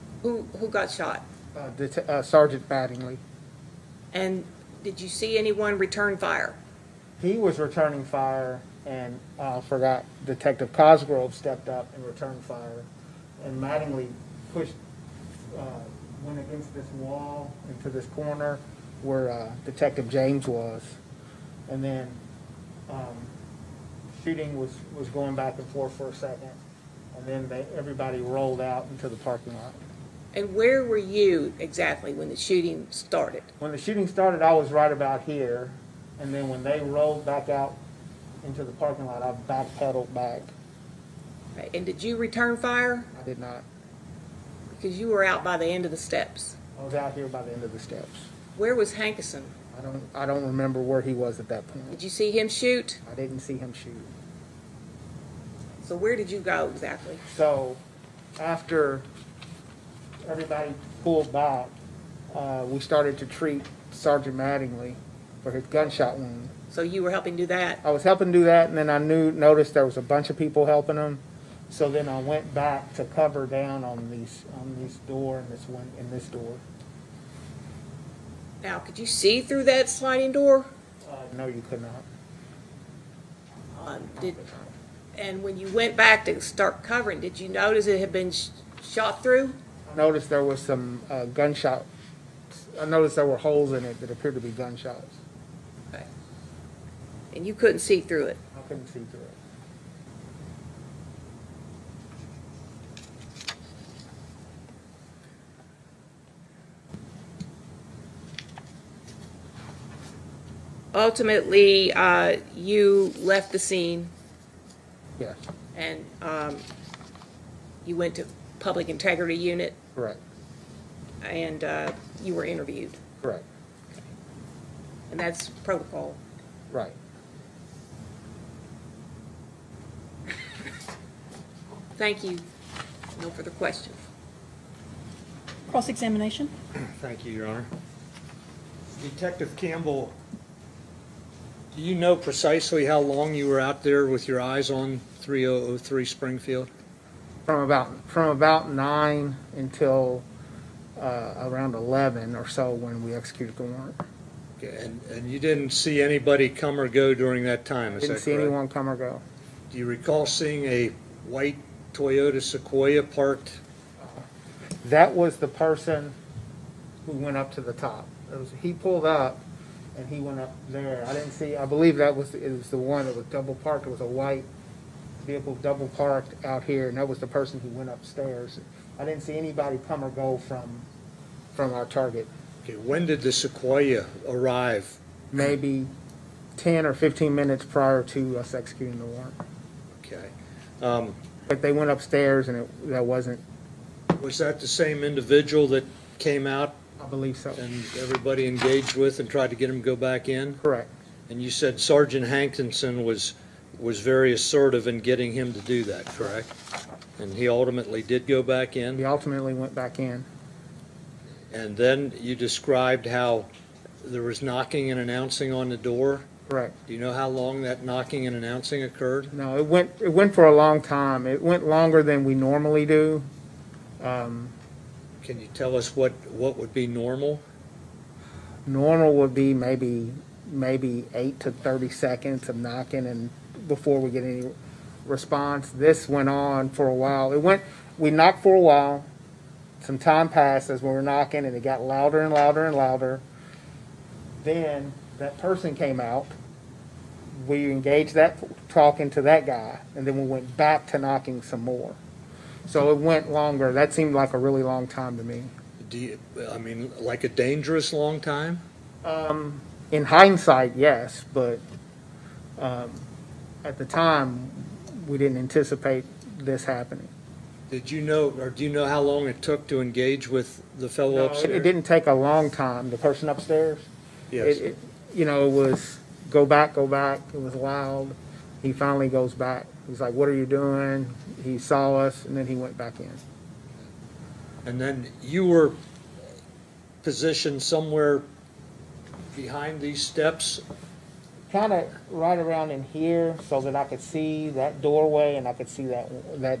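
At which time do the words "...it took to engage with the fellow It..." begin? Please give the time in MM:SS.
04:29.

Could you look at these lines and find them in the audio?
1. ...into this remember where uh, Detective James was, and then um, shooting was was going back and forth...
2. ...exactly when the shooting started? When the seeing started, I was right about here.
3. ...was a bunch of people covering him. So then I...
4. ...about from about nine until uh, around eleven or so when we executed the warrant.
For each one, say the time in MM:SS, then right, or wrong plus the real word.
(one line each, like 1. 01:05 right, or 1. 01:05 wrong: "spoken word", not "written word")
1. 00:17 wrong: "corner", not "remember"
2. 00:31 wrong: "shooting", not "seeing"
3. 01:09 wrong: "helping", not "covering"
4. 02:27 right.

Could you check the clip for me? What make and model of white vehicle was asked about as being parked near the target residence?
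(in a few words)
Toyota Sequoia.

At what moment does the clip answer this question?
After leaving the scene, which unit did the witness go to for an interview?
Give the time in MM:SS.
01:58.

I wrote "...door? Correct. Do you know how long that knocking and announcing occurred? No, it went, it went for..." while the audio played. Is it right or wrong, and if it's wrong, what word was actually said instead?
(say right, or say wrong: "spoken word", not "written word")
right.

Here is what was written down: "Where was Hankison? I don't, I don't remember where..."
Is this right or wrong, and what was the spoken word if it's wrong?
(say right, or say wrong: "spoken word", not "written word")
right.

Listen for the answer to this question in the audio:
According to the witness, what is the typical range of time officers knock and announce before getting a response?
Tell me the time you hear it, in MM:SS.
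03:51.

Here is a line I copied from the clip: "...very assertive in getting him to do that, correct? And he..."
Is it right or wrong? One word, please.
right.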